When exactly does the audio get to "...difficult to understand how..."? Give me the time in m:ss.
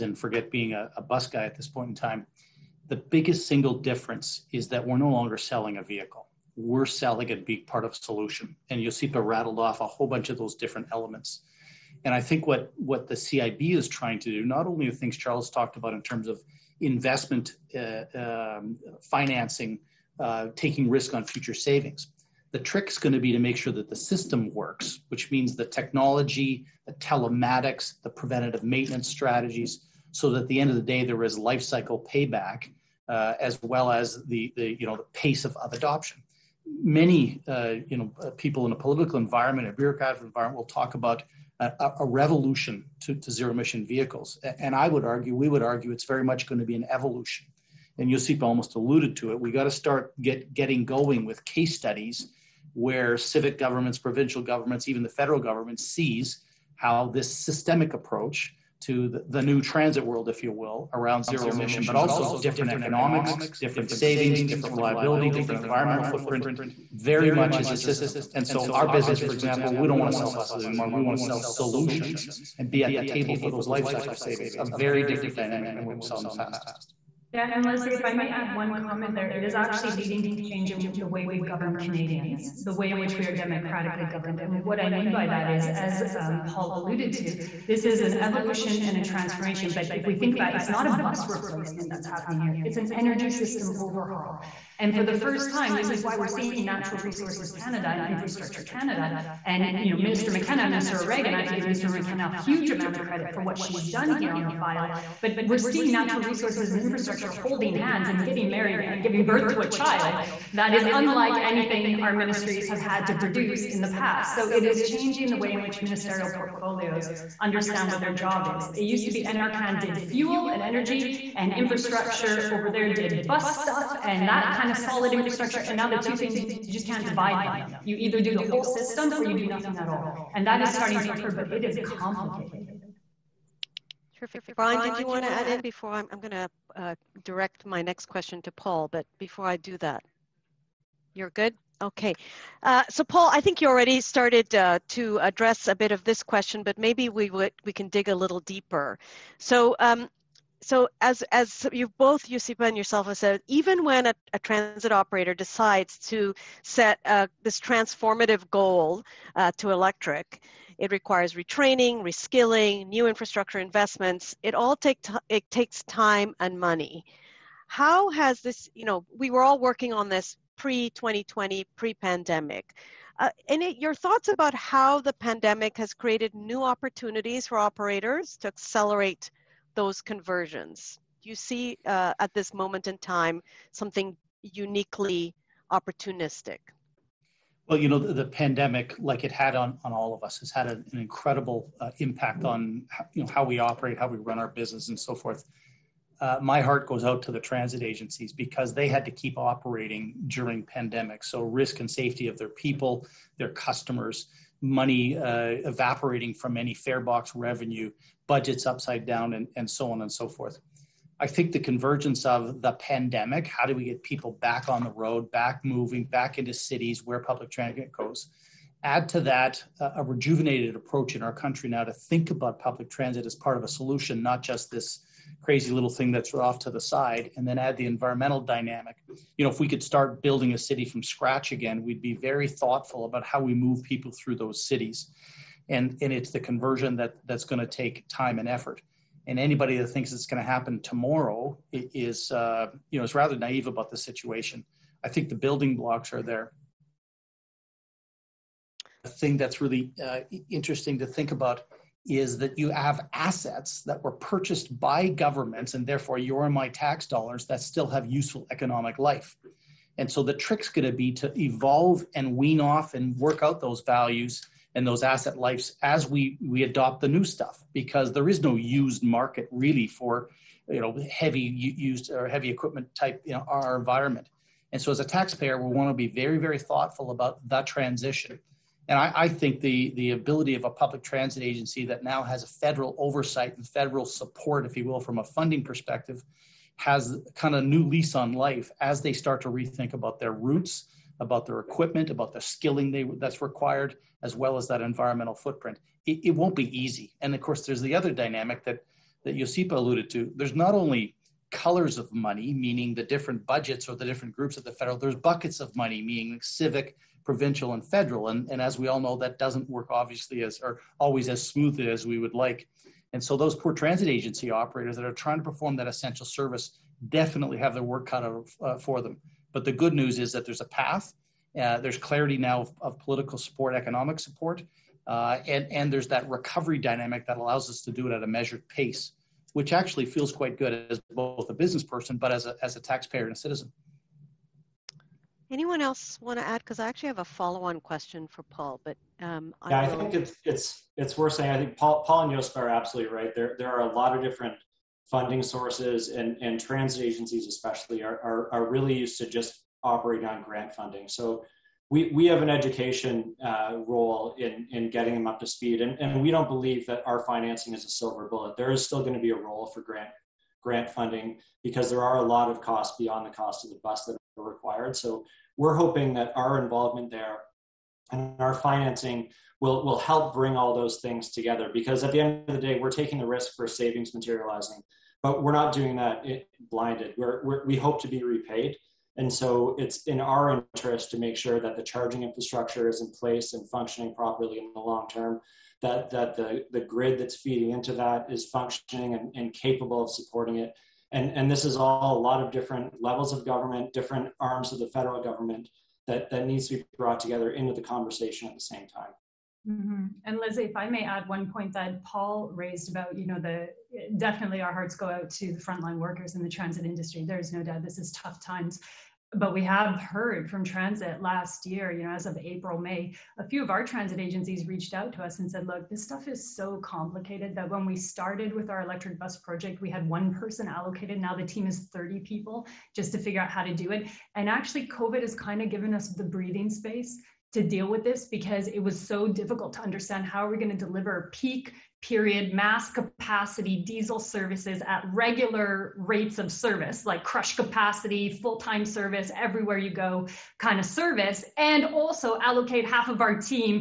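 7:09.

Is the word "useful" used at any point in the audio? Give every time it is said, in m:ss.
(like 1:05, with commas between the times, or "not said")
4:18.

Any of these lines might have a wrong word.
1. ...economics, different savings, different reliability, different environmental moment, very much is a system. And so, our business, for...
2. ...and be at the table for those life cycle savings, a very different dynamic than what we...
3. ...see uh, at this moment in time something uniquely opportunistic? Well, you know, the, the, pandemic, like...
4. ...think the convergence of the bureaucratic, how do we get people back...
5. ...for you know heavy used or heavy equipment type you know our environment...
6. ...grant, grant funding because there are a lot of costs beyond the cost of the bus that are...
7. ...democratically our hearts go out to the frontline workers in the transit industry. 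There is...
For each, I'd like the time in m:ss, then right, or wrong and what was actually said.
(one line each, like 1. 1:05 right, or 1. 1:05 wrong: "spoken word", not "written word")
1. 1:02 wrong: "footprint", not "moment"
2. 1:12 right
3. 3:01 right
4. 3:31 wrong: "pandemic", not "bureaucratic"
5. 4:29 right
6. 5:59 right
7. 6:44 wrong: "definitely", not "democratically".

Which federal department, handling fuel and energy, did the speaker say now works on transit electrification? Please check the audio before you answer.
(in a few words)
Natural Resources Canada.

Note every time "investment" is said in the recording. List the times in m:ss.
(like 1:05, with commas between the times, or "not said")
0:16, 2:43.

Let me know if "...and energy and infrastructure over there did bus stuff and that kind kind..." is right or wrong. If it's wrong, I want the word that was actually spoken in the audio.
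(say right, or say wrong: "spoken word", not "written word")
right.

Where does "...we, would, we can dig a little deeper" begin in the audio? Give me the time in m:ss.
2:27.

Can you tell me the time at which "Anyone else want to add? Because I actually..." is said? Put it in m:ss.
5:35.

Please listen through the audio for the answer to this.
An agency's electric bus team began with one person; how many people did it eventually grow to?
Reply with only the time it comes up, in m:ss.
7:01.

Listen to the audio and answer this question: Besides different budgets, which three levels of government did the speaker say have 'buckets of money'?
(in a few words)
Civic, provincial, and federal.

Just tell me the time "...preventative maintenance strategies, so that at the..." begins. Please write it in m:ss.
0:28.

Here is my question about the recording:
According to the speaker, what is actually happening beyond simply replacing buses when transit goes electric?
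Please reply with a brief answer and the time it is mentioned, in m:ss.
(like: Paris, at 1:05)
An energy system overhaul, at 1:32.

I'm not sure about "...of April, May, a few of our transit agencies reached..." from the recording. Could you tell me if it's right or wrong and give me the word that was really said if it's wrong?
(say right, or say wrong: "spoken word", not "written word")
right.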